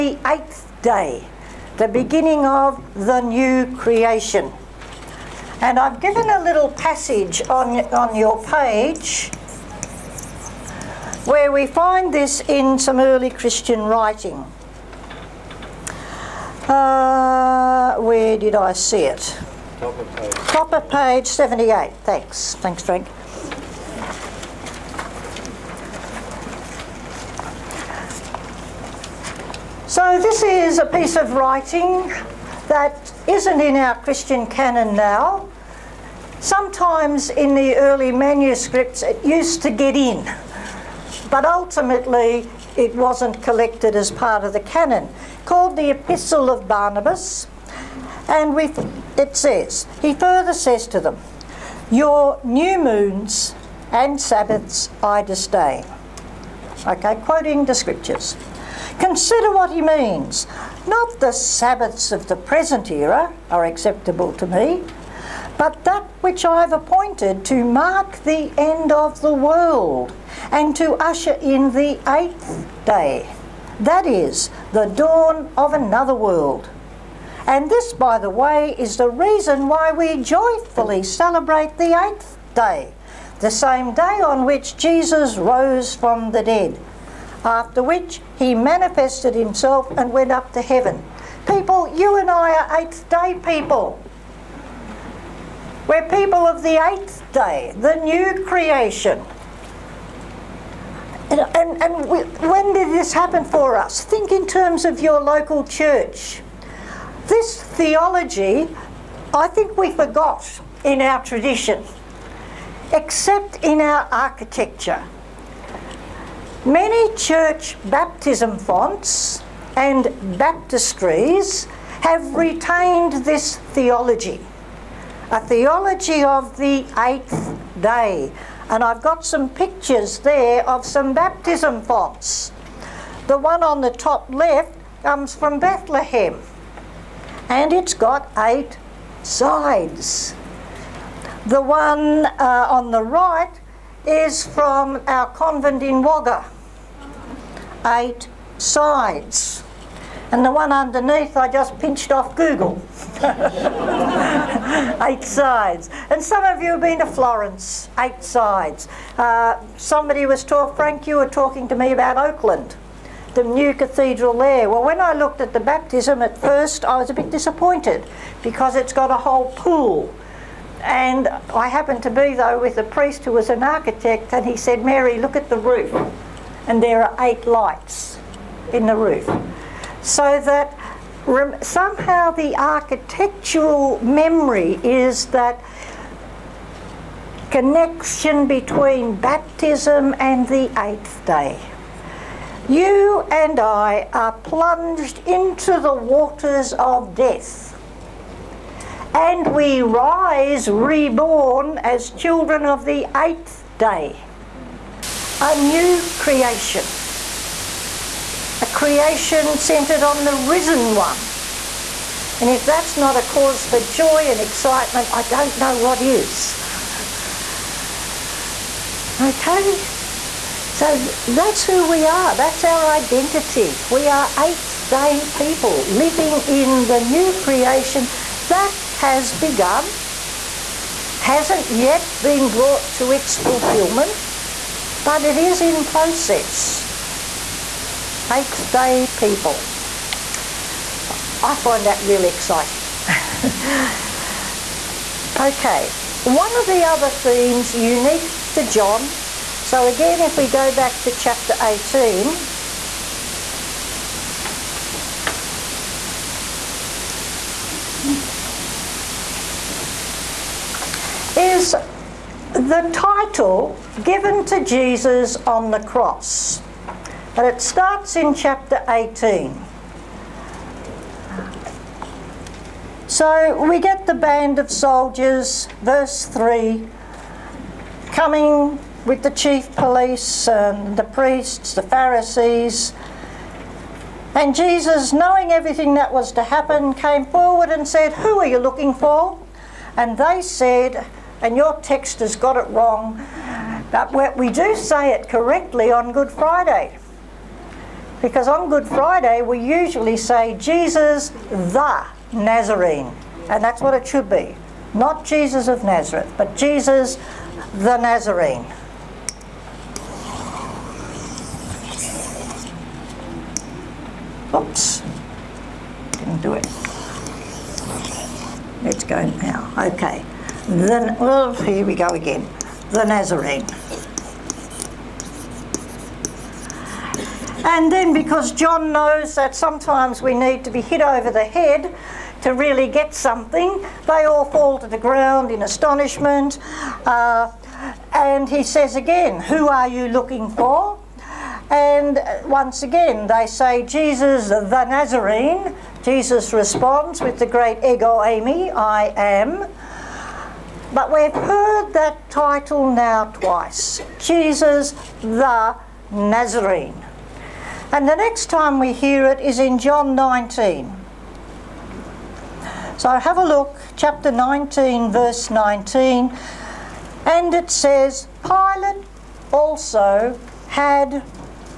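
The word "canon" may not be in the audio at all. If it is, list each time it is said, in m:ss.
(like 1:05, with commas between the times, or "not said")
0:34, 0:44.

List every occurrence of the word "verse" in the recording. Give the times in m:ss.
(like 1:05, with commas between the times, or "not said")
4:35, 6:05.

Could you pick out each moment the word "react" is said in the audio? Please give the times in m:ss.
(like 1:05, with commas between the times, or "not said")
not said.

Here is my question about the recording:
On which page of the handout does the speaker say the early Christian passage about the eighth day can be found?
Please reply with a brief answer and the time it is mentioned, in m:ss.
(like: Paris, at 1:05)
78, at 0:21.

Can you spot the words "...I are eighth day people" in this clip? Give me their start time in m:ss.
1:32.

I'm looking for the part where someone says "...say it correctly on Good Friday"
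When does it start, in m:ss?
4:54.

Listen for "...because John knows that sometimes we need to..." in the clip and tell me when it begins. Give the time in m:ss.
5:28.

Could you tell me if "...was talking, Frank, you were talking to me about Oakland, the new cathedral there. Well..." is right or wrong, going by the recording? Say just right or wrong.
right.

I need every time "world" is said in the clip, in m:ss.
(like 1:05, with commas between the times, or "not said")
1:09, 1:16.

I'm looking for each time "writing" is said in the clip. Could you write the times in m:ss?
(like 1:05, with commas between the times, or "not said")
0:13, 0:31.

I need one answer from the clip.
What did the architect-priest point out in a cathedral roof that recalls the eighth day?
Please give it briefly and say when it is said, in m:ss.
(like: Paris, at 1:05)
eight lights, at 2:57.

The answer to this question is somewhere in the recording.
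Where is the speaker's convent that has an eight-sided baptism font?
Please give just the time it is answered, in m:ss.
2:26.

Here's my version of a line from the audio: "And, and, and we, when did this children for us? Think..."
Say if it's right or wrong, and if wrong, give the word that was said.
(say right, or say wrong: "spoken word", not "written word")
wrong: "happen", not "children".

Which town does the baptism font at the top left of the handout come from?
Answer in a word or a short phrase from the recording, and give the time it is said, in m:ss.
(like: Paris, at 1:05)
Bethlehem, at 2:15.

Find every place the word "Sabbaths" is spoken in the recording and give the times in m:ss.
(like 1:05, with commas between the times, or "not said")
0:54, 1:01.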